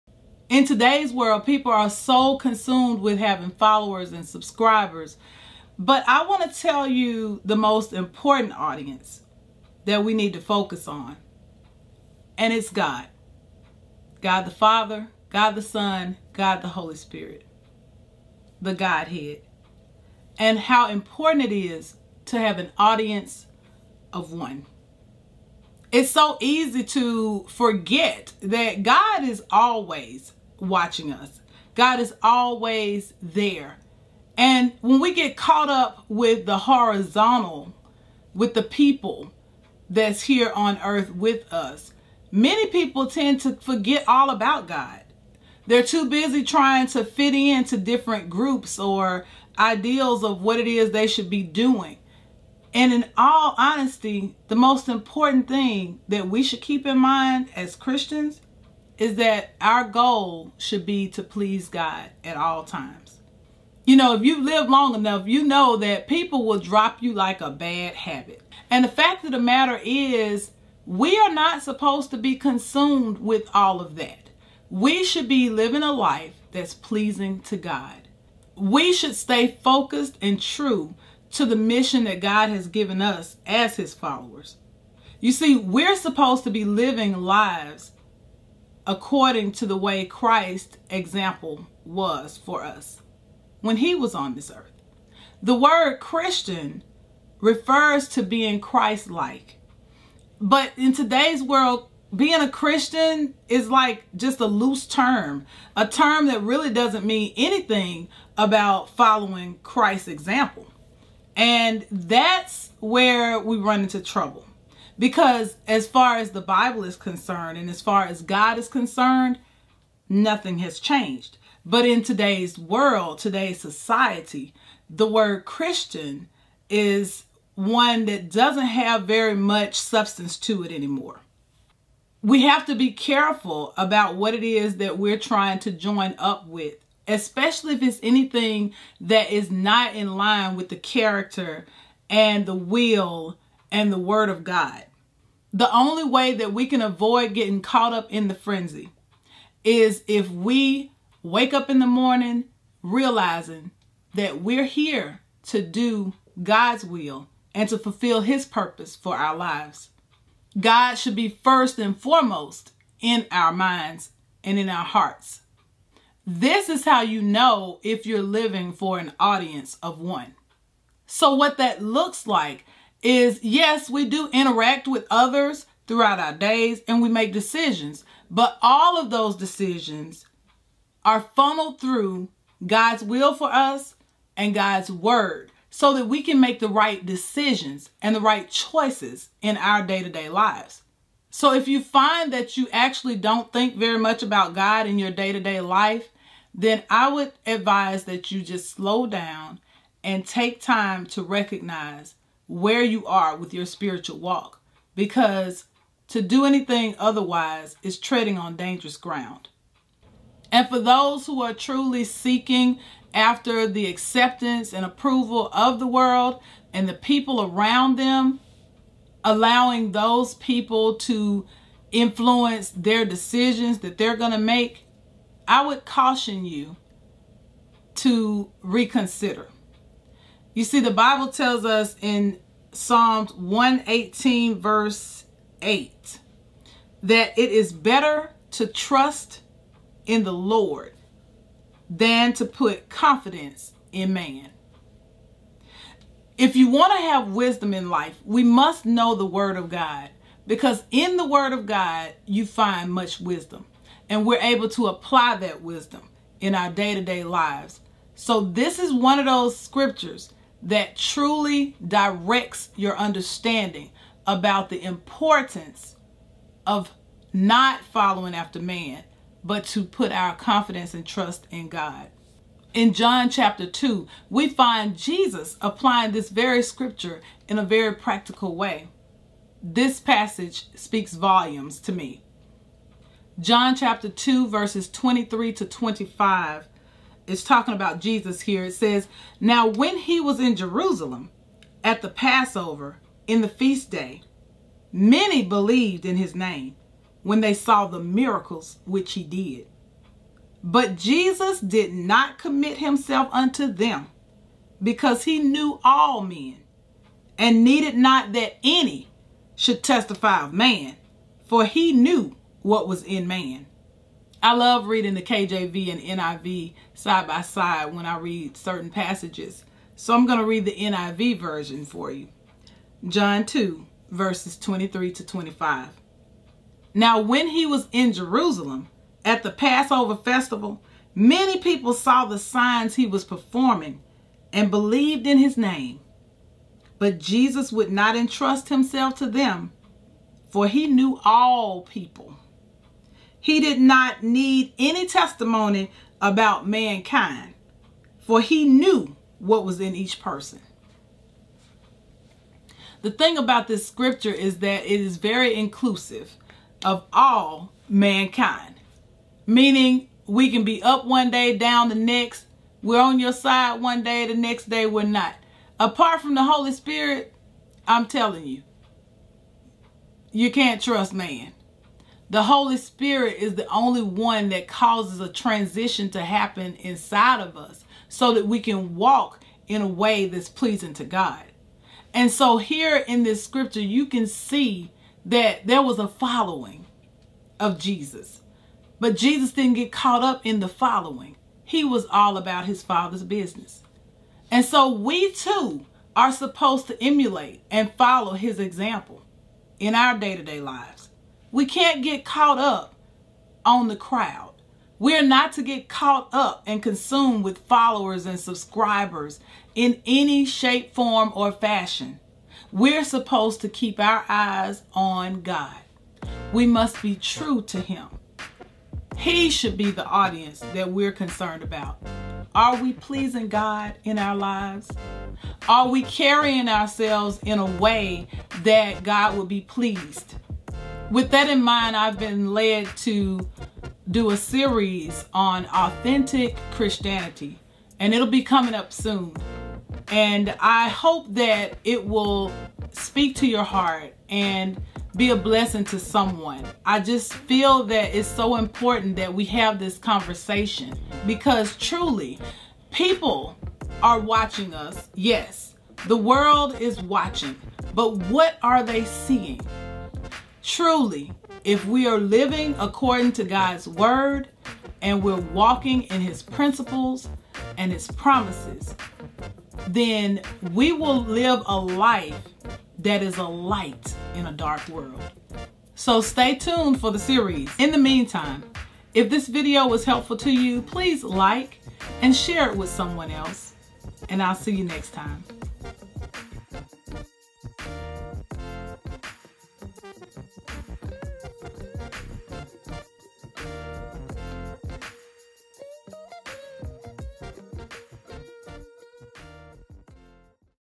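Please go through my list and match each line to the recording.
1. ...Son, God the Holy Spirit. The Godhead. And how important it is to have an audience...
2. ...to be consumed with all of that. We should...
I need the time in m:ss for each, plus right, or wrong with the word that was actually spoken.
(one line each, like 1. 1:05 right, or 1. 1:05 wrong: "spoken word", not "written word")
1. 0:15 right
2. 1:12 right.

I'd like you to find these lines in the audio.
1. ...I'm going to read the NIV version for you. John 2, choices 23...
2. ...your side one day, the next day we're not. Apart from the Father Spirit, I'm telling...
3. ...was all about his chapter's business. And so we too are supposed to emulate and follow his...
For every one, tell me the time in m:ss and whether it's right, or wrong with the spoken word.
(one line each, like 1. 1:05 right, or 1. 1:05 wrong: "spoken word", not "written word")
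1. 5:20 wrong: "verses", not "choices"
2. 6:03 wrong: "Holy", not "Father"
3. 6:31 wrong: "father", not "chapter".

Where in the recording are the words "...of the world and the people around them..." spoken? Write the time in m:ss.
3:35.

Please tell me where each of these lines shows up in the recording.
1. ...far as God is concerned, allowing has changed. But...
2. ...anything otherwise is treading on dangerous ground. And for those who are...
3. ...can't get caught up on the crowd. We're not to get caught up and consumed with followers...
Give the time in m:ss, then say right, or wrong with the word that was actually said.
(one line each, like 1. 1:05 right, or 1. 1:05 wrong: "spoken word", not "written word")
1. 1:57 wrong: "nothing", not "allowing"
2. 3:26 right
3. 6:41 right.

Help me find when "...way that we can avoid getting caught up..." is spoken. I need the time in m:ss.
2:26.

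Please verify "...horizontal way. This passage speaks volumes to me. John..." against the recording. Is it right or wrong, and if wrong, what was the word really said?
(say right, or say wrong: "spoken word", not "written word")
wrong: "practical", not "horizontal".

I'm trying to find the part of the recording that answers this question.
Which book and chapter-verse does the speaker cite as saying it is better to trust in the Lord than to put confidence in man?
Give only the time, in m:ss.
3:52.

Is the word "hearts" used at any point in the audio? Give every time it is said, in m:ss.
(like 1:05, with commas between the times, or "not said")
2:44, 7:23.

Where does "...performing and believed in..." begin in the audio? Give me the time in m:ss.
5:33.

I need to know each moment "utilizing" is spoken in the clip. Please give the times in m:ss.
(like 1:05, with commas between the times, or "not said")
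not said.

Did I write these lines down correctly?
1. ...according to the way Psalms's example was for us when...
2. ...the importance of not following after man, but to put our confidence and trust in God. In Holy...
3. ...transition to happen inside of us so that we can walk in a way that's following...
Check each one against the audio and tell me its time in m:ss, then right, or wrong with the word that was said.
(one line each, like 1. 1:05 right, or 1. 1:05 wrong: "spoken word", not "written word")
1. 1:28 wrong: "Christ", not "Psalms"
2. 4:24 wrong: "John", not "Holy"
3. 6:15 wrong: "pleasing", not "following".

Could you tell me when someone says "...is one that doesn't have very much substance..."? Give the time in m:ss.
2:06.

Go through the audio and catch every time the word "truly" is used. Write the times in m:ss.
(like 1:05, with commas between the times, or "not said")
3:31, 4:20, 7:31, 7:40.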